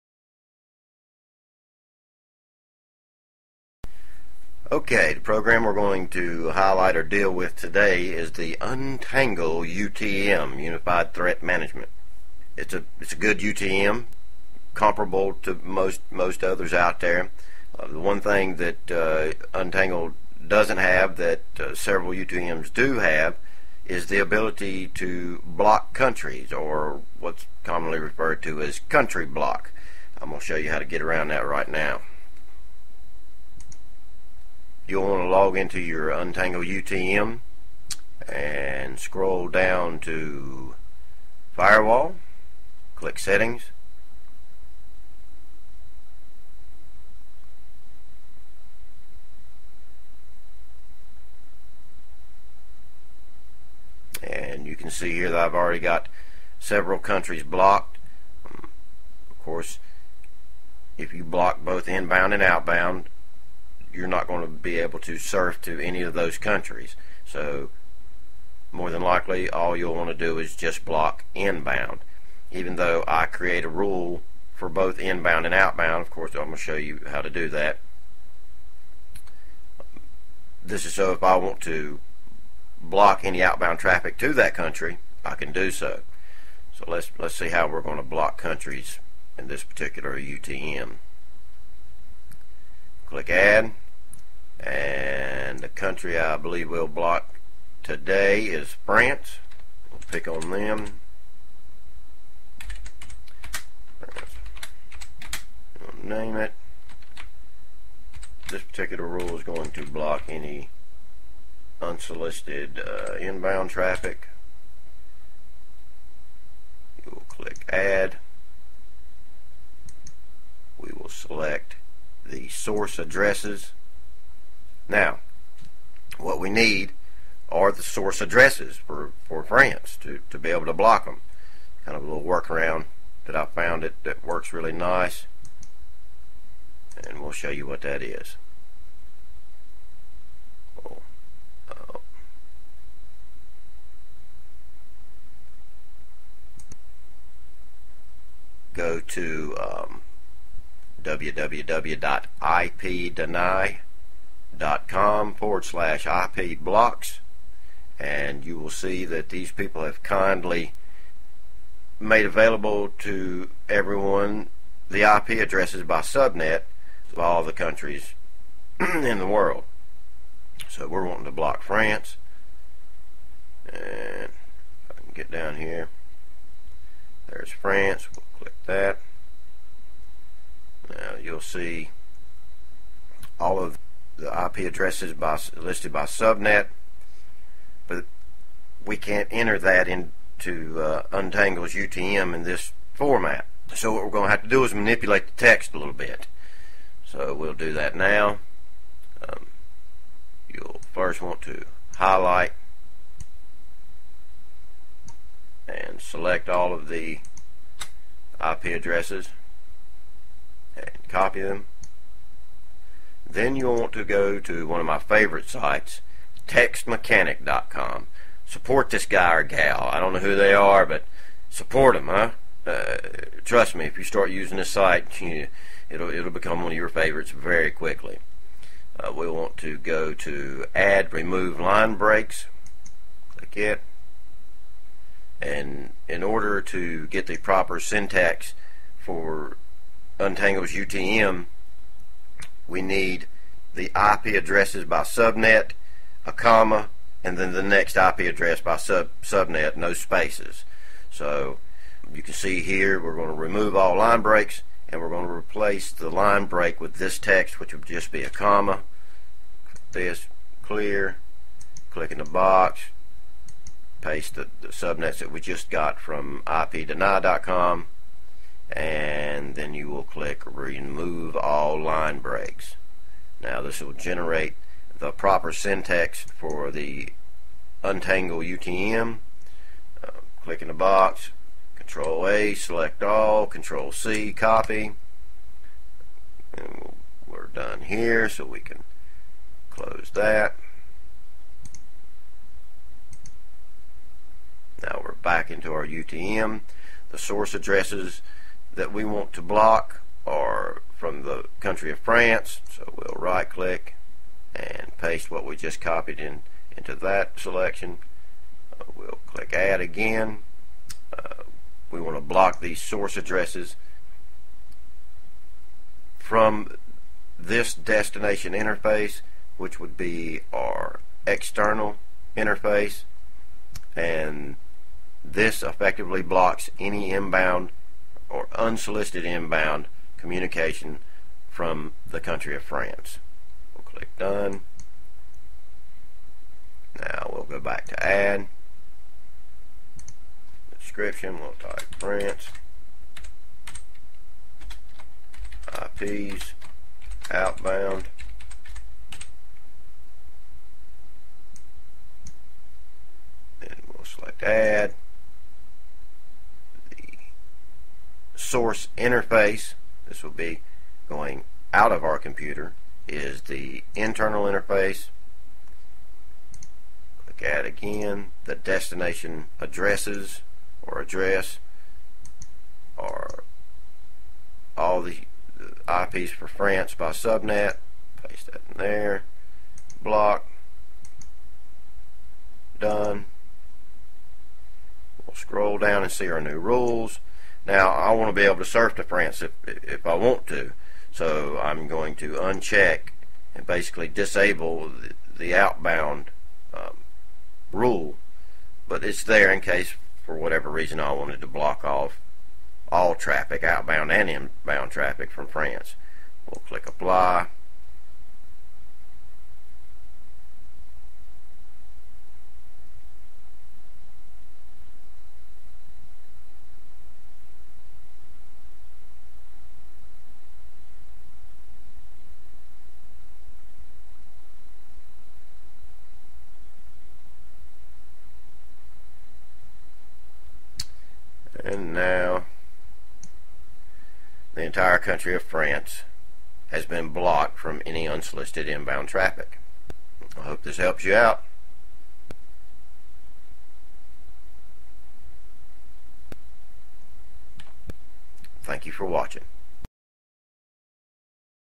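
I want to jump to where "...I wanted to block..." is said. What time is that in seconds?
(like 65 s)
400 s.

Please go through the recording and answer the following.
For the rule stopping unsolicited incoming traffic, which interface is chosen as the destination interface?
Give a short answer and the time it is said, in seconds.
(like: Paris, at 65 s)
external interface, at 321 s.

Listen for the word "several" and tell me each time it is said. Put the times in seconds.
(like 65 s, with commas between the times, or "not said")
21 s, 56 s.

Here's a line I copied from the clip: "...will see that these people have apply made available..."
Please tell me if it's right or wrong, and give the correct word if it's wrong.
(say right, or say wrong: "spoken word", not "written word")
wrong: "kindly", not "apply".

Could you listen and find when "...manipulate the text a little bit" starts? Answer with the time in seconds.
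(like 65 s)
194 s.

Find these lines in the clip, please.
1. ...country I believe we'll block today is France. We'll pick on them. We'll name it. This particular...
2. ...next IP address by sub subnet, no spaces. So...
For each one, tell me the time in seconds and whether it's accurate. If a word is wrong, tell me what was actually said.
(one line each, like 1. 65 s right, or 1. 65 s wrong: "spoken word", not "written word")
1. 95 s right
2. 247 s right.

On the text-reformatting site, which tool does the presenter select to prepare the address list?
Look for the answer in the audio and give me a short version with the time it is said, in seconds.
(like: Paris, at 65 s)
add remove line breaks, at 230 s.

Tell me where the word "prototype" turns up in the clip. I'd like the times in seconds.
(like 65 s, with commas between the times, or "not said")
not said.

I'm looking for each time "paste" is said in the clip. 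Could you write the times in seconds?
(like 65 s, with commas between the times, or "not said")
264 s, 304 s, 378 s.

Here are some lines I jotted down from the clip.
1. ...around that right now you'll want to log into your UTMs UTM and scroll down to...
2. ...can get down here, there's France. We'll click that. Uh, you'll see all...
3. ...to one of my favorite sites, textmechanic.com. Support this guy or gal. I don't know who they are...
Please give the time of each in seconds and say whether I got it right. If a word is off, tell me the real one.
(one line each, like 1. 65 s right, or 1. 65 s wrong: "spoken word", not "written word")
1. 31 s wrong: "Untangle", not "UTMs"
2. 175 s right
3. 214 s right.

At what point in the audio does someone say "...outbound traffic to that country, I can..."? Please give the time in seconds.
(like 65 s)
83 s.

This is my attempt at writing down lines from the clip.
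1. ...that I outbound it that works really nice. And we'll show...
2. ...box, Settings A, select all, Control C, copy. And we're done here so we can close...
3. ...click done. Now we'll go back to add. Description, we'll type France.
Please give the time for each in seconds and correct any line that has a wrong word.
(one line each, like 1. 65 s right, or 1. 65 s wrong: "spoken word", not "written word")
1. 133 s wrong: "found", not "outbound"
2. 280 s wrong: "Control", not "Settings"
3. 333 s right.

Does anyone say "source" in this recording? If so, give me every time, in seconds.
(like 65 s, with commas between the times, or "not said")
122 s, 127 s, 297 s, 312 s, 358 s.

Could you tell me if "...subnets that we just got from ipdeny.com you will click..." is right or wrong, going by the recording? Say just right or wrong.
right.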